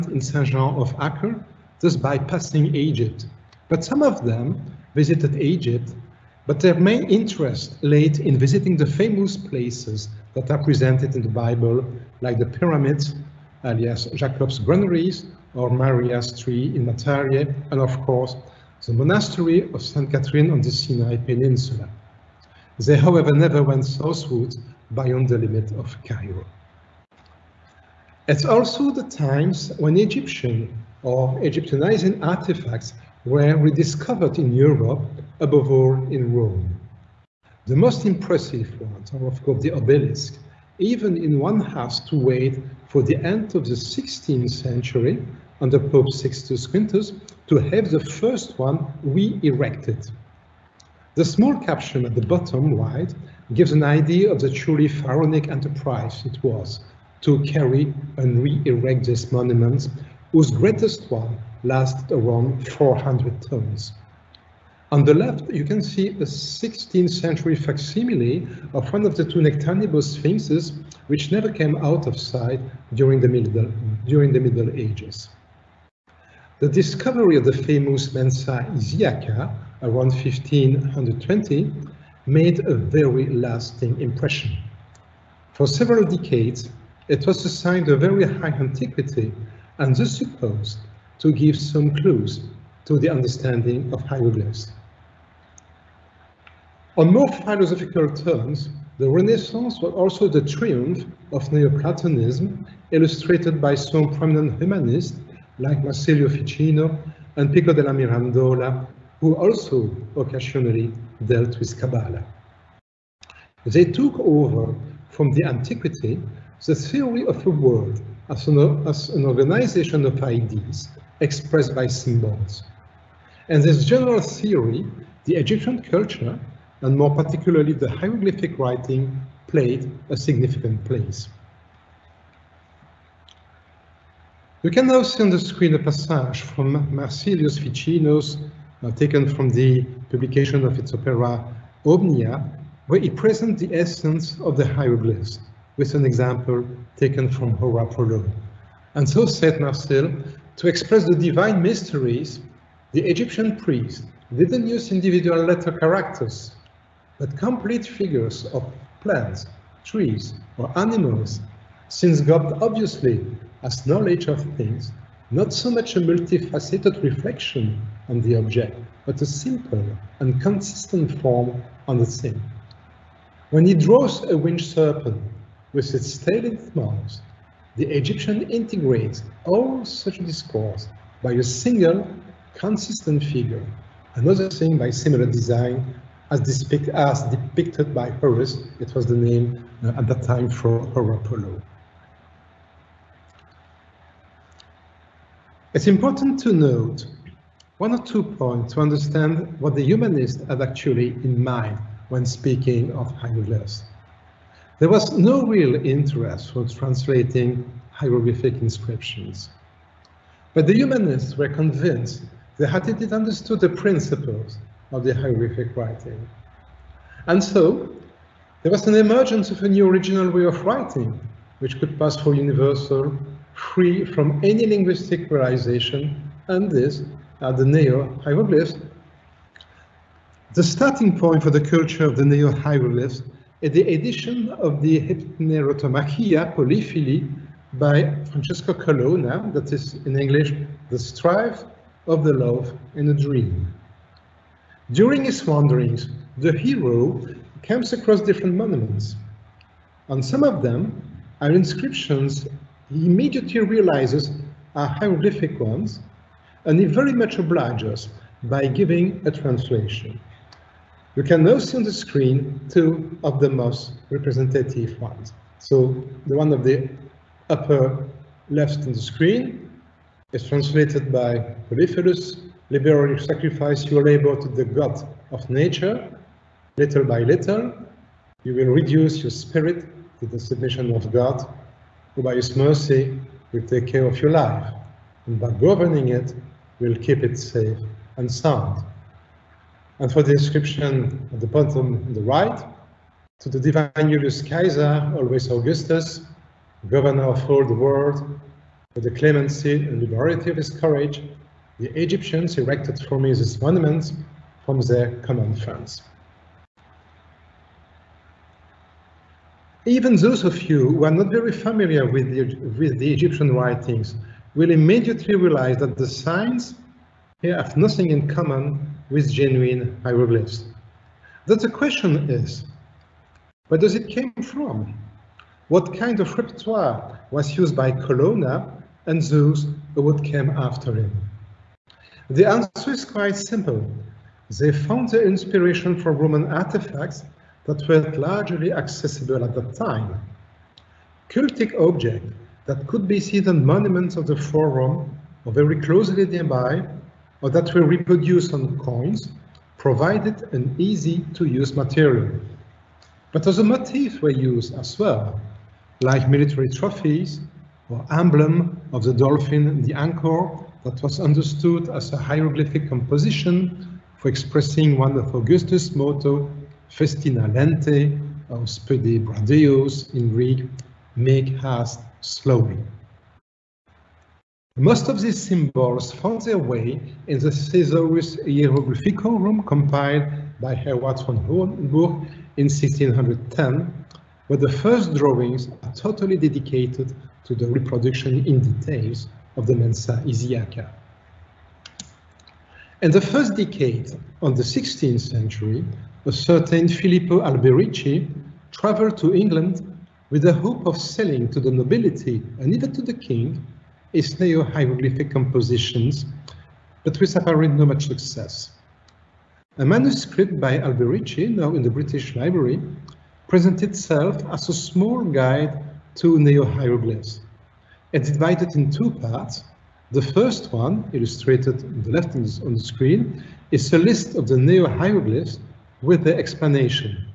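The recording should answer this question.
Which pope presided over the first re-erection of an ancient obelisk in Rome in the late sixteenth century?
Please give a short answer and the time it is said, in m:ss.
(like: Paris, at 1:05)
Sixtus Quintus, at 0:46.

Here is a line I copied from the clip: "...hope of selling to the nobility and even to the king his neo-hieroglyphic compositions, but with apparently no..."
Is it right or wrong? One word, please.
right.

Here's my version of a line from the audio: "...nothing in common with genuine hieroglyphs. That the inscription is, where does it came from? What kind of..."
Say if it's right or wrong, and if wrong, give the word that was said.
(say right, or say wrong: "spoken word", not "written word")
wrong: "question", not "inscription".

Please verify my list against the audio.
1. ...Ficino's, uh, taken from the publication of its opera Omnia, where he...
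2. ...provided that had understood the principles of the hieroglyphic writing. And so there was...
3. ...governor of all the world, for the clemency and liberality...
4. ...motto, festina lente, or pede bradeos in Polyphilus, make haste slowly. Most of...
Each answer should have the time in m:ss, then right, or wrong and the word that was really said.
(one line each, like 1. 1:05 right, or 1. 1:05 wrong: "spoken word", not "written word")
1. 2:17 right
2. 3:31 wrong: "convinced", not "provided"
3. 4:56 right
4. 6:05 wrong: "Greek", not "Polyphilus".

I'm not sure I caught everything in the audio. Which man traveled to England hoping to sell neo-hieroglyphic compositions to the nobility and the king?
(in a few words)
Filippo Alberici.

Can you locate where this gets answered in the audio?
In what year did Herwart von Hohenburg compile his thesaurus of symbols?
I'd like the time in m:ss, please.
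6:22.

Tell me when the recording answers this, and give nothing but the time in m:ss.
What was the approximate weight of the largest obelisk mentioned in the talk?
1:02.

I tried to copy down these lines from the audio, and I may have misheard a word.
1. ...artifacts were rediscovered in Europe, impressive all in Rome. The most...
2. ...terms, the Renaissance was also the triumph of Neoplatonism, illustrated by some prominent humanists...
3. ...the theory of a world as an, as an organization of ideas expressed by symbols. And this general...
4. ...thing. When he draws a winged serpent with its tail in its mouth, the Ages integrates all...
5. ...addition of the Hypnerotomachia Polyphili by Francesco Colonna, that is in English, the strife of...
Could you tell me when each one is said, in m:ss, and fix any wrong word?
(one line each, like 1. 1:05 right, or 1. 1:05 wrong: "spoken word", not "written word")
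1. 0:32 wrong: "above", not "impressive"
2. 1:38 right
3. 1:56 right
4. 2:52 wrong: "Egyptian", not "Ages"
5. 3:53 right.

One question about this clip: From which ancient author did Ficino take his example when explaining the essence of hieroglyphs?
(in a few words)
Horapollo.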